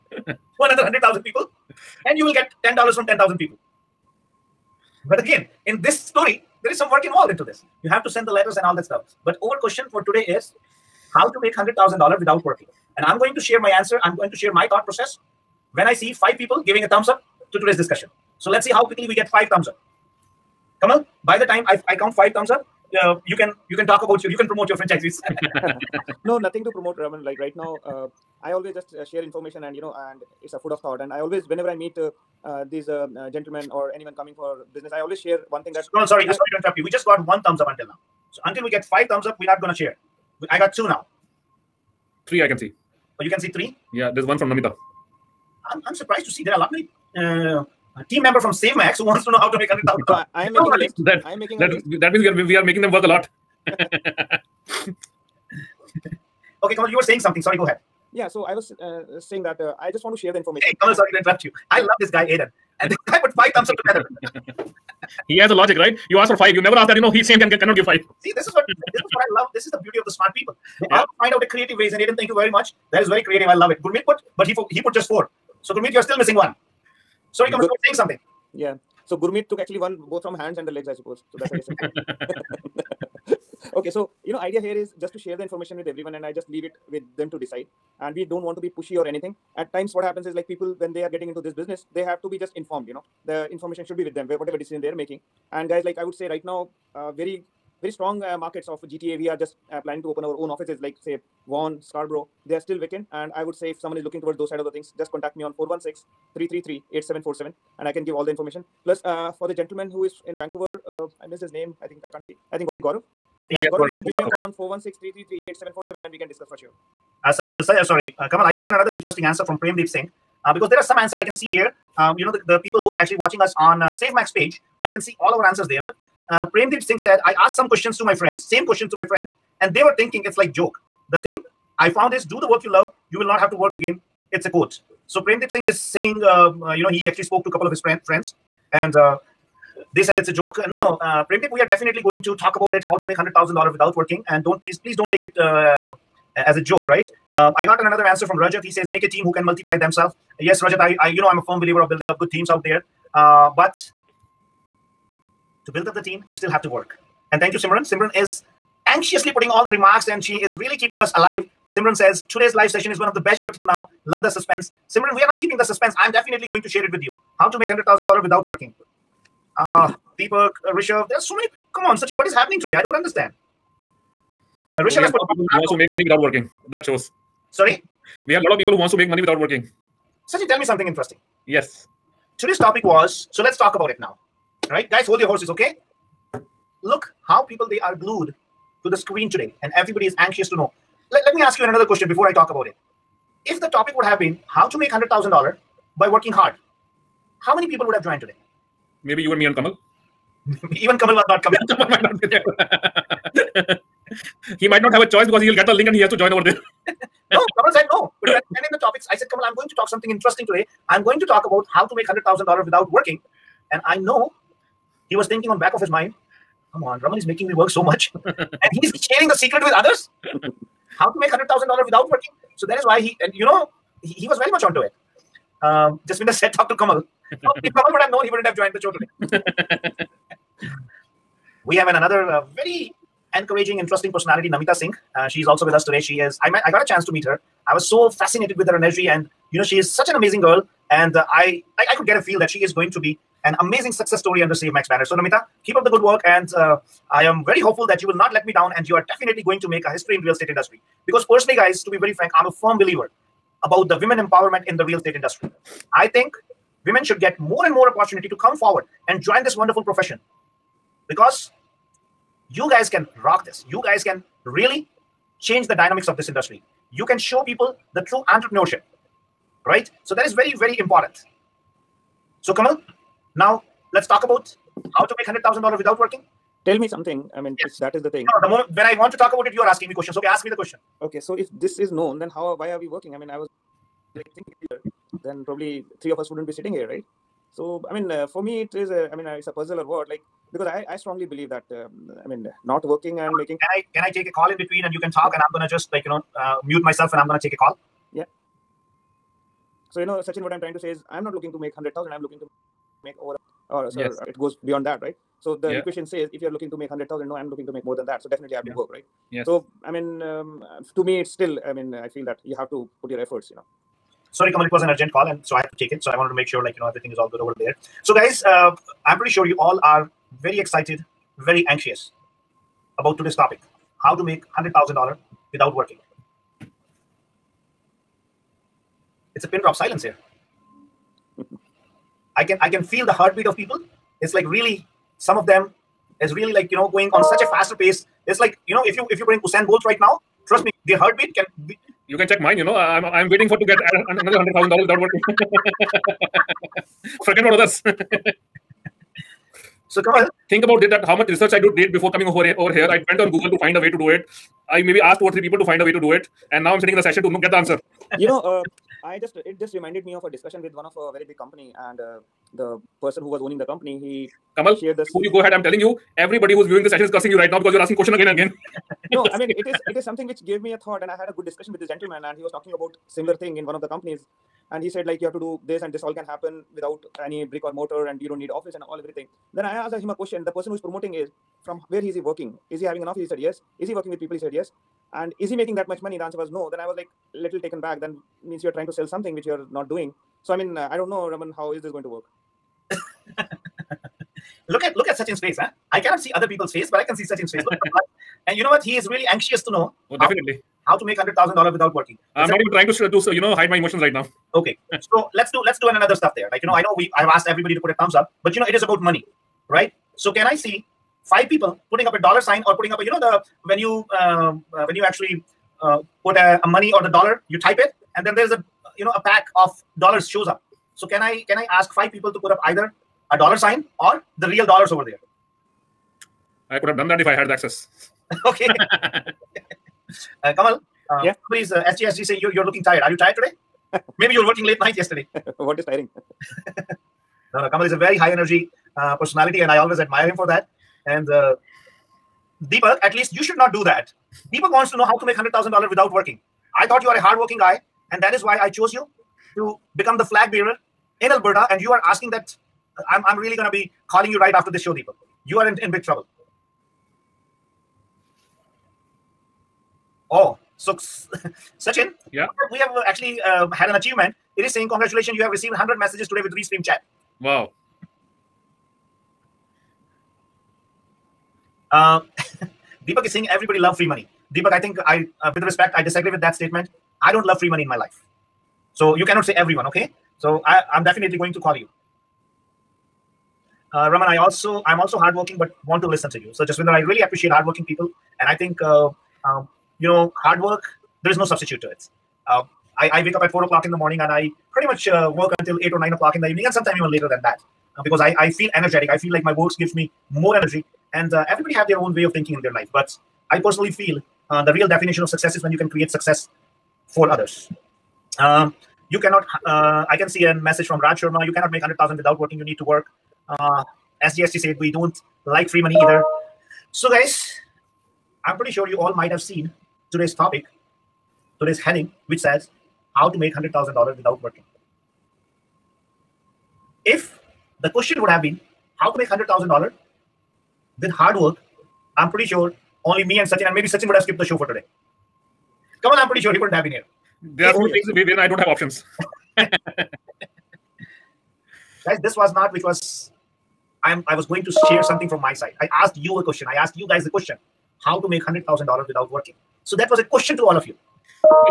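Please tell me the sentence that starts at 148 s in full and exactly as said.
He says, make a team who can multiply themselves.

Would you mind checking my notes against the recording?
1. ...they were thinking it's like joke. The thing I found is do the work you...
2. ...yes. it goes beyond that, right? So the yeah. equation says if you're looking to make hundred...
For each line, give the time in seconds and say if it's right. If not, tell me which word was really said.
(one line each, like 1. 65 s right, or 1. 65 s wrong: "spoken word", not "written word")
1. 129 s right
2. 303 s right.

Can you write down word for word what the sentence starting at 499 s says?
I feel like my works gives me more energy.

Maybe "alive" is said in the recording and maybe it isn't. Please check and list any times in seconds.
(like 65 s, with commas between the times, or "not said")
161 s.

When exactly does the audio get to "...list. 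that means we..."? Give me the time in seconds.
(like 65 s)
51 s.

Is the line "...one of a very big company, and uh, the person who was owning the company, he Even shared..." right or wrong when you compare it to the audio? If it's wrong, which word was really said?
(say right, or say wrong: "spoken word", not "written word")
wrong: "Kamal", not "Even".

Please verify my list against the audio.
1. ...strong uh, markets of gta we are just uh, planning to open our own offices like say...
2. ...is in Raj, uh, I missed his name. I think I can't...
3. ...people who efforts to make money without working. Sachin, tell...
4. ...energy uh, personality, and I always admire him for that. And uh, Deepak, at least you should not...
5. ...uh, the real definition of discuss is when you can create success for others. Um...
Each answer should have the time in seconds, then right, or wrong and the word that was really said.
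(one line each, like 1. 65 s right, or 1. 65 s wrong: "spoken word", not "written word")
1. 97 s right
2. 110 s wrong: "Vancouver", not "Raj"
3. 178 s wrong: "wants", not "efforts"
4. 438 s right
5. 504 s wrong: "success", not "discuss".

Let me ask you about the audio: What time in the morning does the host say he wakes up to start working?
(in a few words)
4 o'clock.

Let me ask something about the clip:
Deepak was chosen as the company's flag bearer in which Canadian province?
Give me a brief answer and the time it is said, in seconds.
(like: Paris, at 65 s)
Alberta, at 451 s.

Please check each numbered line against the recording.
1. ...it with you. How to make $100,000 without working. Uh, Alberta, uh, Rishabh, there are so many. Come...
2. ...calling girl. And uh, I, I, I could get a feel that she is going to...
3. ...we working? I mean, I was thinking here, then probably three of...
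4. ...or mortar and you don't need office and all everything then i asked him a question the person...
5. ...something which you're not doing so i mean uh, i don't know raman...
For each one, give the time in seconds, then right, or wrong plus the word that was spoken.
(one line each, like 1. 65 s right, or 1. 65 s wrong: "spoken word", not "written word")
1. 166 s wrong: "Deepak", not "Alberta"
2. 240 s wrong: "amazing", not "calling"
3. 282 s right
4. 377 s right
5. 389 s right.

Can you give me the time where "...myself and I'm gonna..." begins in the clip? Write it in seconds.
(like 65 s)
296 s.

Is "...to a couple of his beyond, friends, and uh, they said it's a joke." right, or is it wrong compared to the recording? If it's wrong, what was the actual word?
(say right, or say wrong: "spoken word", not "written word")
wrong: "friend", not "beyond".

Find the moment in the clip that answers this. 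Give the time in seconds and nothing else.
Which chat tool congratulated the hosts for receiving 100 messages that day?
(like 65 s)
466 s.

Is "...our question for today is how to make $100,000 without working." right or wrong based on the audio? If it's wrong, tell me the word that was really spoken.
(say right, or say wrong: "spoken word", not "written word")
right.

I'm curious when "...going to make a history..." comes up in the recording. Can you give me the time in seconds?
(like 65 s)
249 s.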